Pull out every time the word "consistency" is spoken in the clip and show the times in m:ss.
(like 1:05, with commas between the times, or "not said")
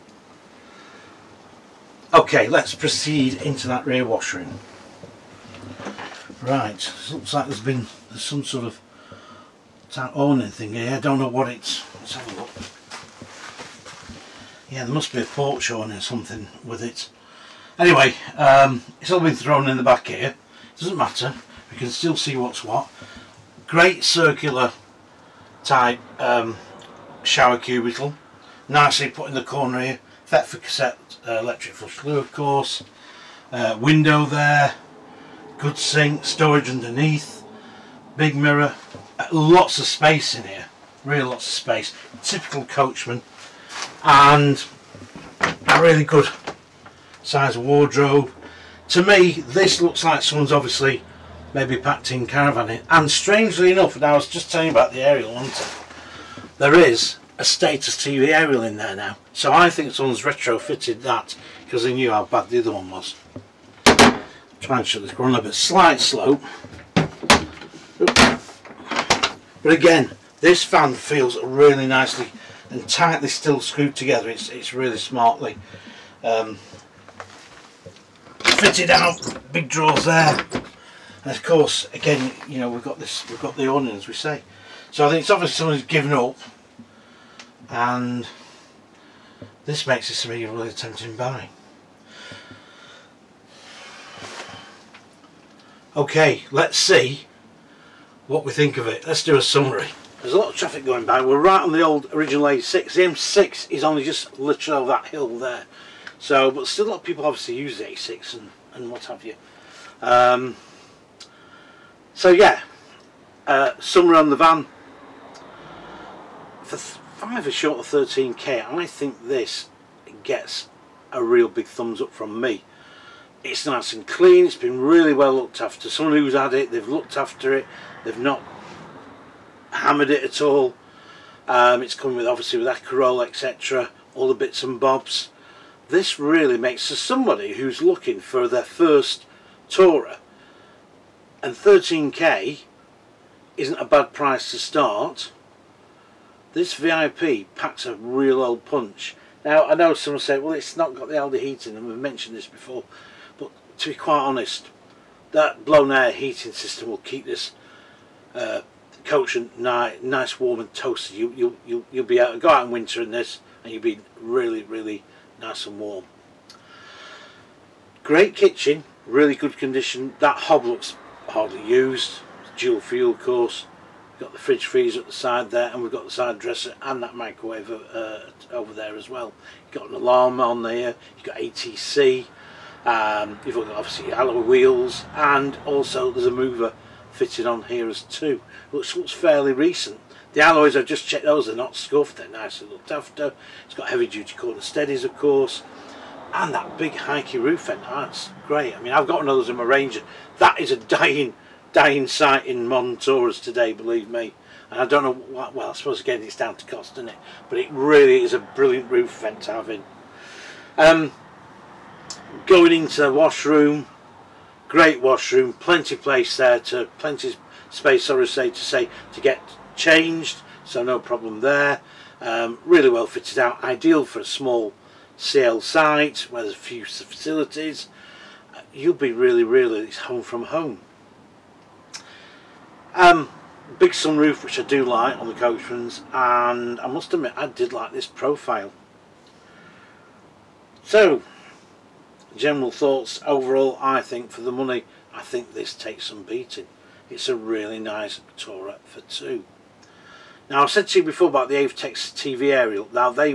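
not said.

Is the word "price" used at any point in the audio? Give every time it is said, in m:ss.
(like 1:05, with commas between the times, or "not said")
2:24.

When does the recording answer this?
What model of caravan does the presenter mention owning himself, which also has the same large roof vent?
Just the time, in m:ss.
3:19.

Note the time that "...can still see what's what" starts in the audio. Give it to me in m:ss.
0:21.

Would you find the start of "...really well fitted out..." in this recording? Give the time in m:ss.
3:42.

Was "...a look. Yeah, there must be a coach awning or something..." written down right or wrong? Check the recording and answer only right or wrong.
wrong.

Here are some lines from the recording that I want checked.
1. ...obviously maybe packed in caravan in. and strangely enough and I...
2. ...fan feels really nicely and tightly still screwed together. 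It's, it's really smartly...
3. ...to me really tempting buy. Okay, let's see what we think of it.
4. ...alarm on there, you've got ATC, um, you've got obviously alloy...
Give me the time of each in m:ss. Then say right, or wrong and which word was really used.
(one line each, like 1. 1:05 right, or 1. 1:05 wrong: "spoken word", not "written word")
1. 0:50 right
2. 1:10 right
3. 1:30 right
4. 2:59 right.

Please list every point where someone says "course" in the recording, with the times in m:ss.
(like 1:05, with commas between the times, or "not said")
0:32, 1:21, 2:53, 3:15.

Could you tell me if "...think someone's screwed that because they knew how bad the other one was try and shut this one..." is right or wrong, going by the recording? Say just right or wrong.
wrong.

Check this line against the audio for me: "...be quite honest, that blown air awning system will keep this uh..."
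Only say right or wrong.
wrong.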